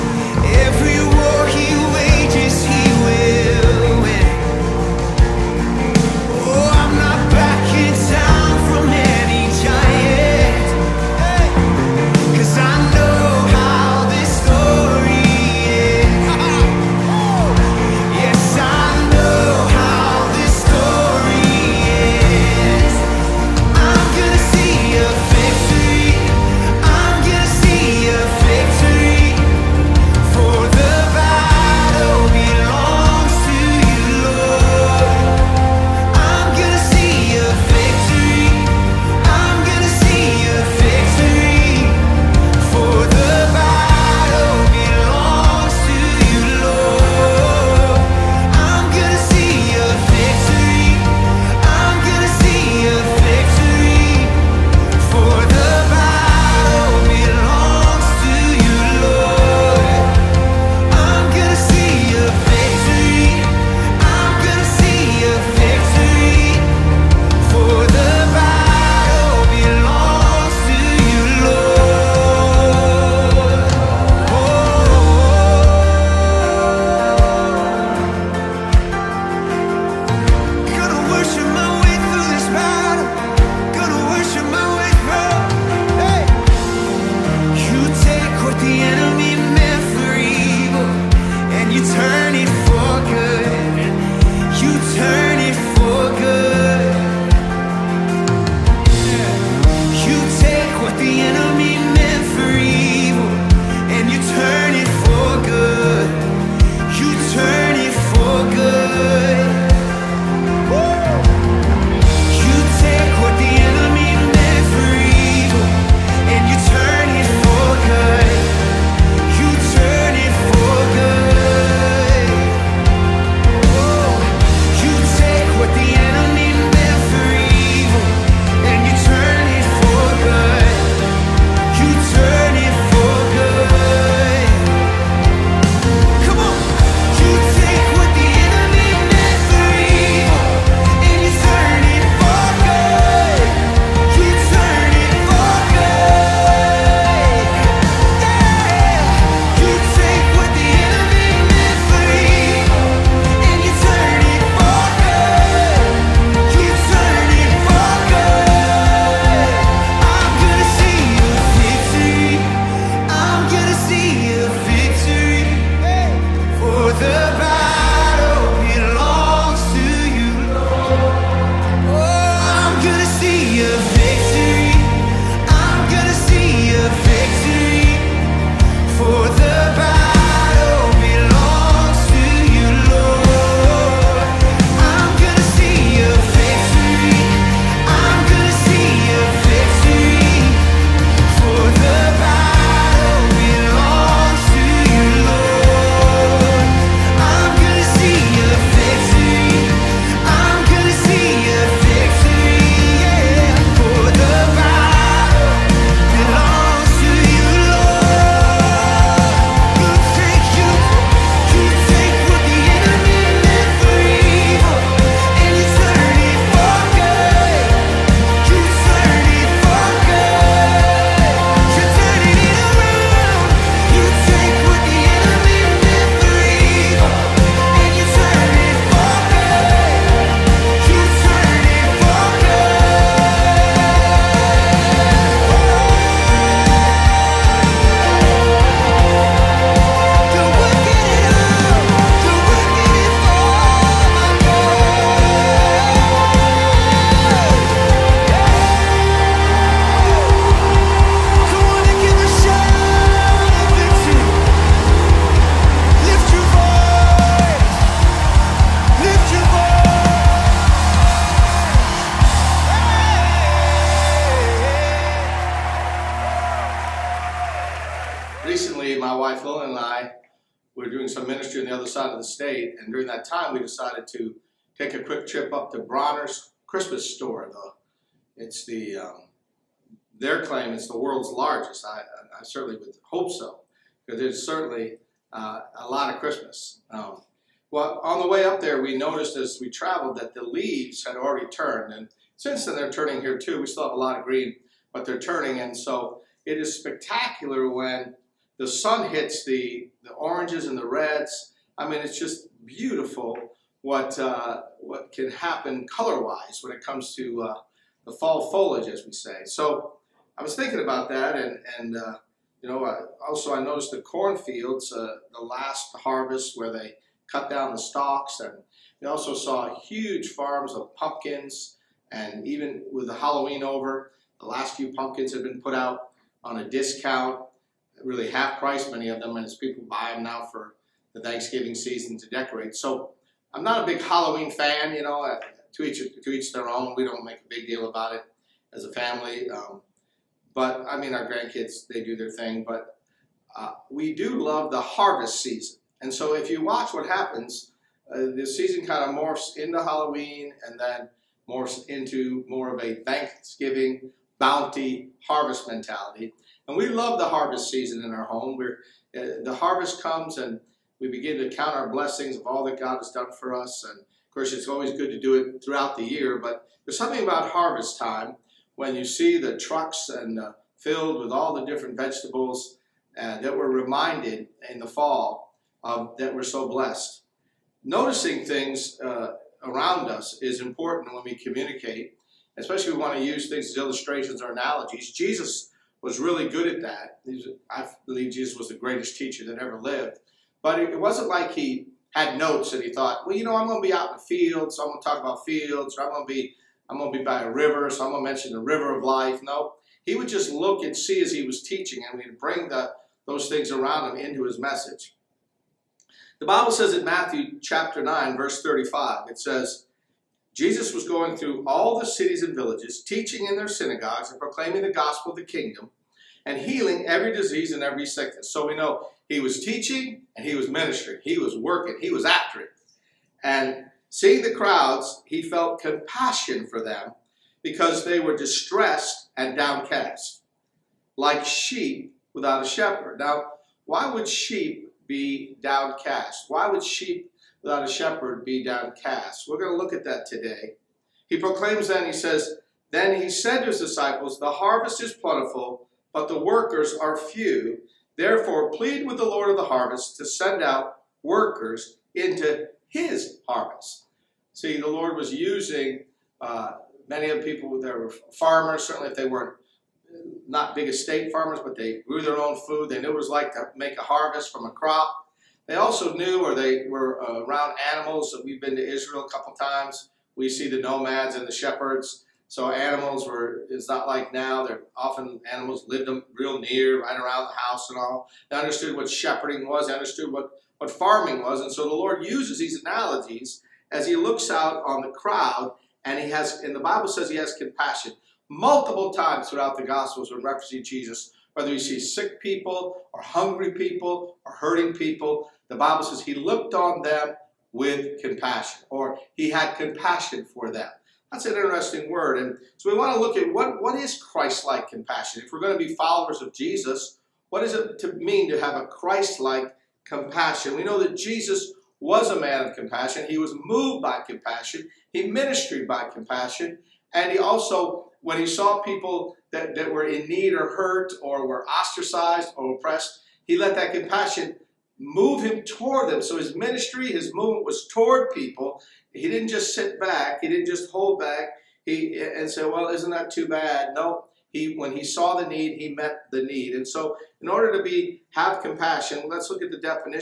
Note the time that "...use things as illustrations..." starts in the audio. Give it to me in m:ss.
6:23.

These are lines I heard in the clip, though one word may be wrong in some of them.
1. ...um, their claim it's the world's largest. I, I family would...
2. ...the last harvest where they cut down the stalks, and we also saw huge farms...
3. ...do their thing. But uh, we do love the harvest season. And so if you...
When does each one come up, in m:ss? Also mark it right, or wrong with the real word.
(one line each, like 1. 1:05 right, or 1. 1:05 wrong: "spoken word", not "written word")
1. 4:38 wrong: "certainly", not "family"
2. 5:15 right
3. 5:42 right.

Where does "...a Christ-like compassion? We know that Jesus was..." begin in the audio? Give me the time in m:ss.
8:28.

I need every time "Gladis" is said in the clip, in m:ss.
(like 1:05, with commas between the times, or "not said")
not said.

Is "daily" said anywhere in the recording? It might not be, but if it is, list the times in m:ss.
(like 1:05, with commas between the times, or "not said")
not said.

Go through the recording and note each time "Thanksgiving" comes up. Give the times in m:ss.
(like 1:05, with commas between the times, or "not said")
5:31, 5:53.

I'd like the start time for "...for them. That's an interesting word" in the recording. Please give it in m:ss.
8:20.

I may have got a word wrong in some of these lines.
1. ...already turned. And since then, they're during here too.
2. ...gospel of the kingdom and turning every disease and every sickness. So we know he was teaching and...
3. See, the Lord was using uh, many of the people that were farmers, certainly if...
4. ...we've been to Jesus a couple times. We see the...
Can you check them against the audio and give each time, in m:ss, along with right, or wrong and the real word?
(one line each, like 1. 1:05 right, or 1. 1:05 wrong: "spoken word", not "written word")
1. 4:51 wrong: "turning", not "during"
2. 6:54 wrong: "healing", not "turning"
3. 7:34 right
4. 7:48 wrong: "Israel", not "Jesus".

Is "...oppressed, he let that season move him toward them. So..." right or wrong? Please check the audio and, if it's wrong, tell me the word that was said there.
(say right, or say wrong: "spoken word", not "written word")
wrong: "compassion", not "season".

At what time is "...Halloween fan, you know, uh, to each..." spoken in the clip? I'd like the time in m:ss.
5:34.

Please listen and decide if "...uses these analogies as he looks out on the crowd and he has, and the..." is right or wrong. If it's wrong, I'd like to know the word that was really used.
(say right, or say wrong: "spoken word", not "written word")
right.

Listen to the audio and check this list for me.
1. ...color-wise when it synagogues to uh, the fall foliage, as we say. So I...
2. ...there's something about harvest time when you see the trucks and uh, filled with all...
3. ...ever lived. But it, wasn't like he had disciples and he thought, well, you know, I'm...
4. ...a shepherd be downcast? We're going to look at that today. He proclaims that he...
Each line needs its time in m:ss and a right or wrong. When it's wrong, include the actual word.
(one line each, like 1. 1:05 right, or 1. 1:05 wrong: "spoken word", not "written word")
1. 5:05 wrong: "comes", not "synagogues"
2. 6:06 right
3. 6:29 wrong: "notes", not "disciples"
4. 7:17 right.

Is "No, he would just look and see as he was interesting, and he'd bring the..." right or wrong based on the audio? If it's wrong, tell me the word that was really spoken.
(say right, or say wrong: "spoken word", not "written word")
wrong: "teaching", not "interesting".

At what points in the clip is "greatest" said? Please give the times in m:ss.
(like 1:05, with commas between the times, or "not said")
6:28.